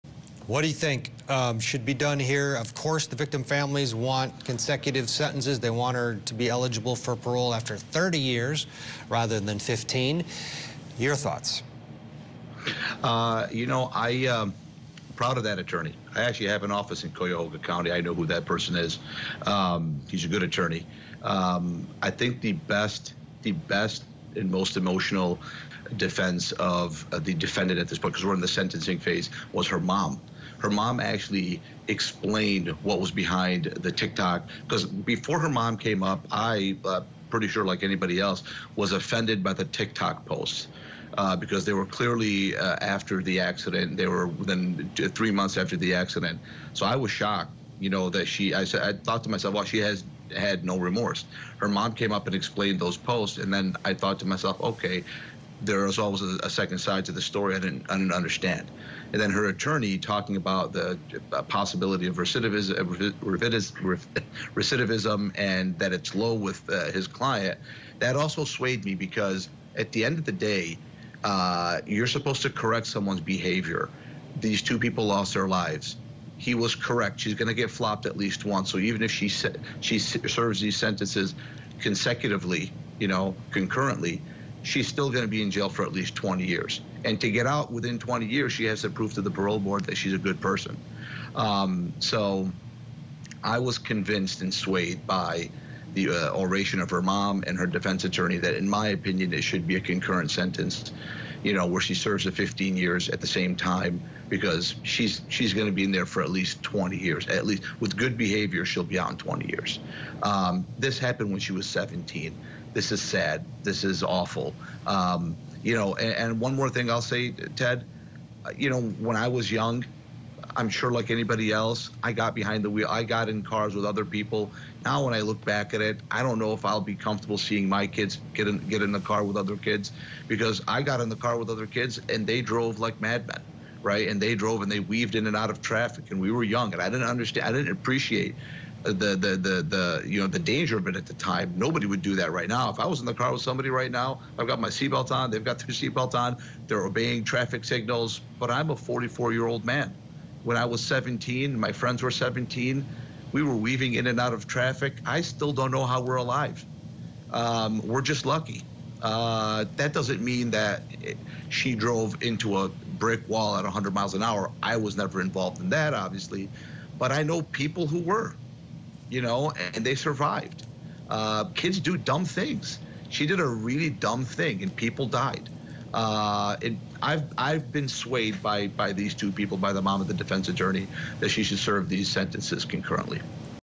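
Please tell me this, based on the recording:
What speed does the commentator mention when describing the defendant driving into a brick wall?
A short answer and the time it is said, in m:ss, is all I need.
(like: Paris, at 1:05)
100 miles an hour, at 2:43.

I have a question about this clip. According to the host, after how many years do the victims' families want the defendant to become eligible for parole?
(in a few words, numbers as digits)
30 years.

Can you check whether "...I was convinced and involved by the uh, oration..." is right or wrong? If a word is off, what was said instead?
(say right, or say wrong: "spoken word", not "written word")
wrong: "swayed", not "involved".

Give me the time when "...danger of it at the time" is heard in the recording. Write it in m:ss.
2:20.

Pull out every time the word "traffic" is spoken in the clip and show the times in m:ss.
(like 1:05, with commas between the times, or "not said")
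2:15, 2:27, 2:34.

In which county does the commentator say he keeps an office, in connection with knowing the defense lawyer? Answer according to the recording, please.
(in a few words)
Cuyahoga County.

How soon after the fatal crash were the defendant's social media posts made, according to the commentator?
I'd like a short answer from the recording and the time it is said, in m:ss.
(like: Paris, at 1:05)
within three months, at 0:44.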